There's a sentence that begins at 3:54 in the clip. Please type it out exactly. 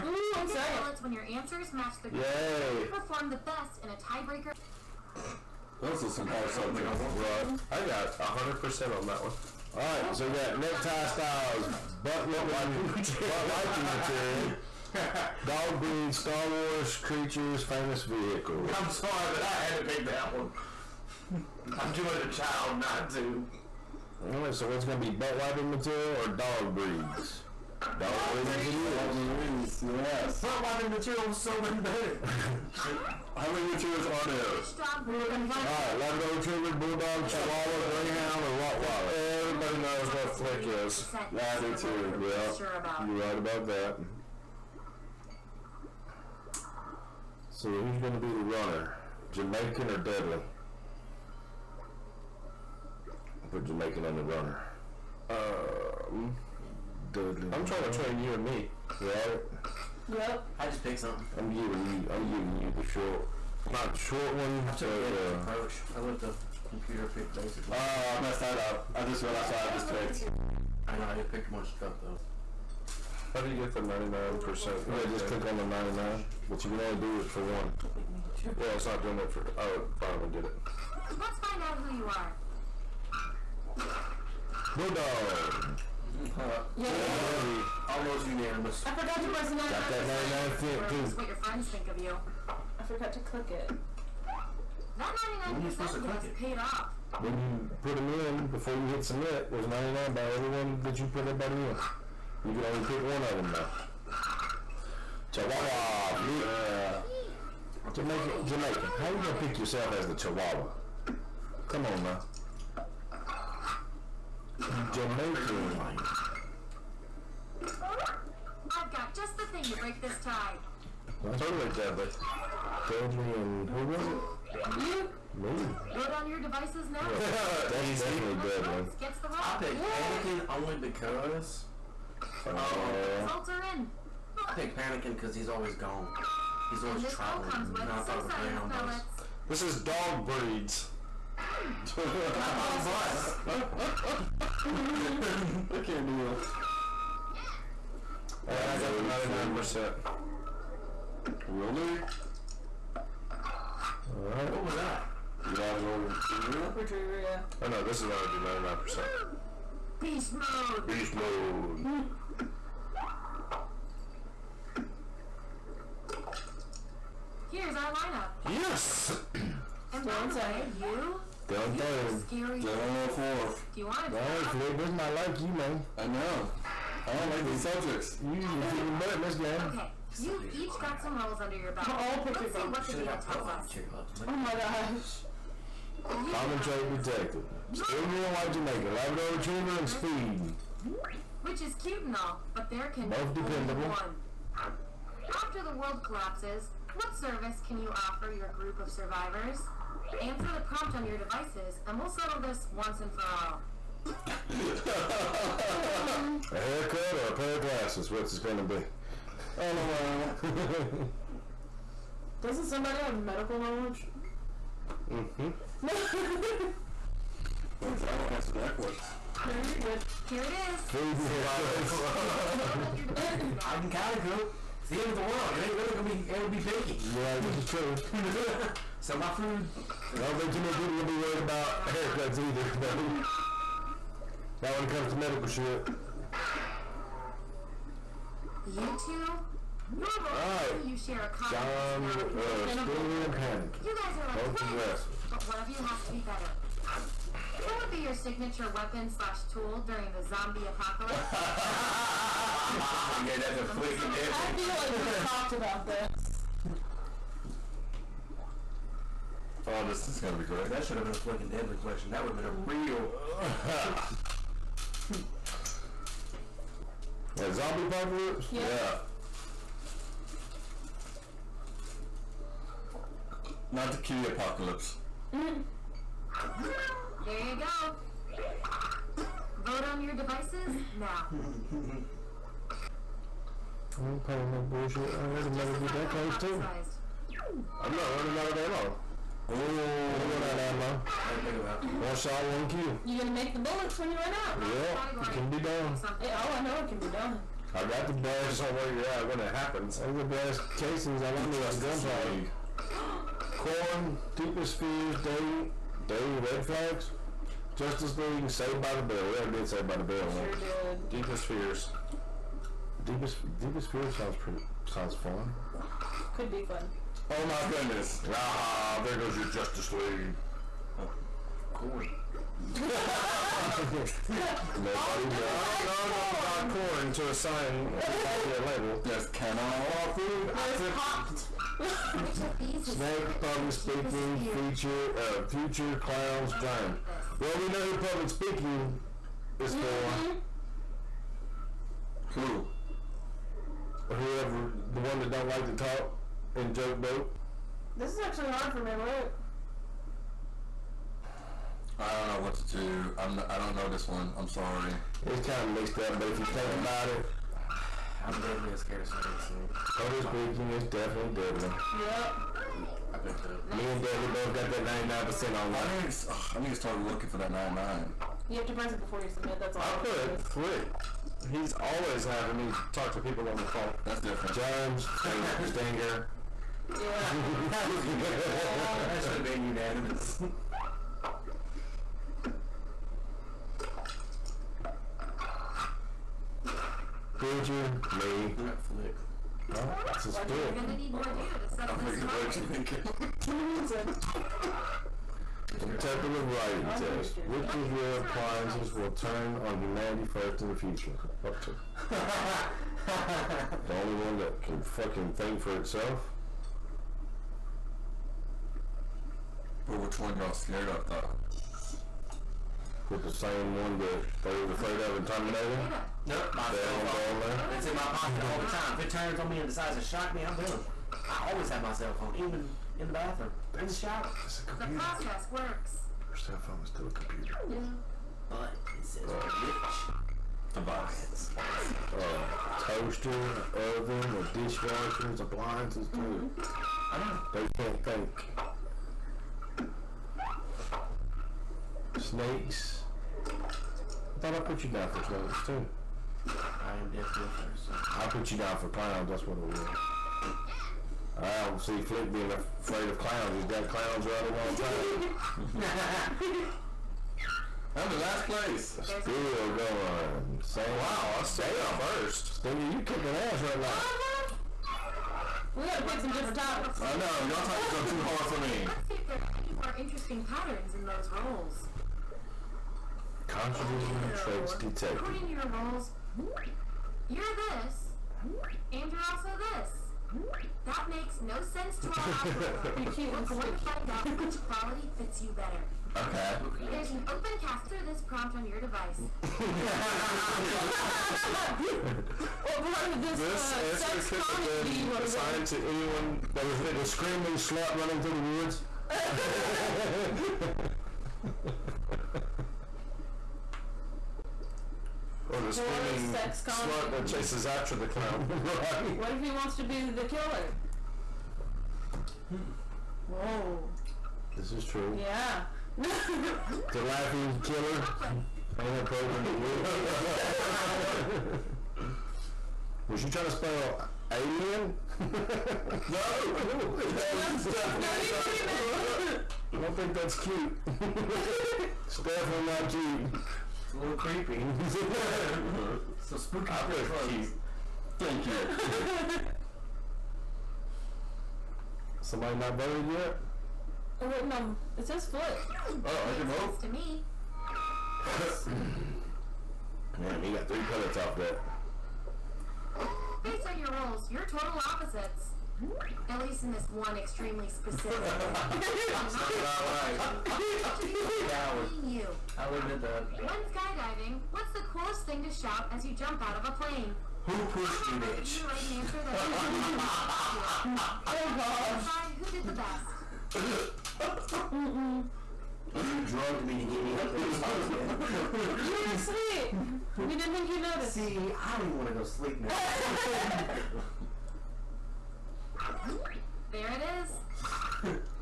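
Not when it comes to medical shit.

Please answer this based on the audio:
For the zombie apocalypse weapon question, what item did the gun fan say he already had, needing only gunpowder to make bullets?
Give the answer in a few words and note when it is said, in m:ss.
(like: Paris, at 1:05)
Brass casings, at 5:00.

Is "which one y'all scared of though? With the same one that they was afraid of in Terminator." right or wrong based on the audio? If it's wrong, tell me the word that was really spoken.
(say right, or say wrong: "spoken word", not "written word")
right.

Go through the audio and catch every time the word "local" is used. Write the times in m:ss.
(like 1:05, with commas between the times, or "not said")
not said.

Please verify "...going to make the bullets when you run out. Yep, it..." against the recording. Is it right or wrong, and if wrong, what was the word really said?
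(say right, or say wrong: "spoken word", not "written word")
right.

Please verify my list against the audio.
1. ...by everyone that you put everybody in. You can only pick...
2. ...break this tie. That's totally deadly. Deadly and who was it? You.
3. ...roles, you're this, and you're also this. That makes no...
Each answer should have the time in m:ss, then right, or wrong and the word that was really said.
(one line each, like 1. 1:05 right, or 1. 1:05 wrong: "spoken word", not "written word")
1. 1:40 right
2. 1:59 right
3. 7:55 right.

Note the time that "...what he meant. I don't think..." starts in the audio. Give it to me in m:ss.
8:48.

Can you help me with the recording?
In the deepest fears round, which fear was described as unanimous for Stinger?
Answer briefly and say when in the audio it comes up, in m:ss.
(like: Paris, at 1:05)
Germs, at 6:14.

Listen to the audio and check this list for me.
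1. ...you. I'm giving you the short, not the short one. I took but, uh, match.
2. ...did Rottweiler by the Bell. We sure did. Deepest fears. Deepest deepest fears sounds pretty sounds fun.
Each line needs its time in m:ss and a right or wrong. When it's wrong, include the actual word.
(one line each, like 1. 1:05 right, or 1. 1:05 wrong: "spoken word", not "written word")
1. 1:01 wrong: "approach", not "match"
2. 5:09 wrong: "Saved", not "Rottweiler".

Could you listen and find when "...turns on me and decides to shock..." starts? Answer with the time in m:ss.
6:59.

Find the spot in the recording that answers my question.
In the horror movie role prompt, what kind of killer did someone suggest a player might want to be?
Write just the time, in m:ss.
8:37.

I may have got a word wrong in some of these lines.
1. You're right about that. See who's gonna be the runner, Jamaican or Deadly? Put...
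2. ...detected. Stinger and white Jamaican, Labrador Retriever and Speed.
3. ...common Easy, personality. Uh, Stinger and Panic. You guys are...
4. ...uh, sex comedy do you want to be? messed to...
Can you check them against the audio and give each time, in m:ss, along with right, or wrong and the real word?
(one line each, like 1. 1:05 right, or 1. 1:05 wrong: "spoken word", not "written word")
1. 0:43 right
2. 3:06 right
3. 4:01 wrong: "John", not "Easy"
4. 8:13 wrong: "assigned", not "messed".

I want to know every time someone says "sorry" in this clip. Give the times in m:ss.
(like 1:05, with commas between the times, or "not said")
0:00, 0:18, 5:54.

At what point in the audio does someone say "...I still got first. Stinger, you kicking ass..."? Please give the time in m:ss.
7:41.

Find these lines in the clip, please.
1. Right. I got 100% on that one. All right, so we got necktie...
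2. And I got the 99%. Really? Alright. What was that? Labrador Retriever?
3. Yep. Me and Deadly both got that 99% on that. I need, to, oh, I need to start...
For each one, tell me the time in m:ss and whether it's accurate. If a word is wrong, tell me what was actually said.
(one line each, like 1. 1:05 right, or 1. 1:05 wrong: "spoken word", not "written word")
1. 0:07 right
2. 2:28 right
3. 6:02 right.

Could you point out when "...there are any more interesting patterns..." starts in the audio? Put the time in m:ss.
7:49.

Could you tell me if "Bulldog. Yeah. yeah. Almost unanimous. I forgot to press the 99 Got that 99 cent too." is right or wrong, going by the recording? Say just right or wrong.
right.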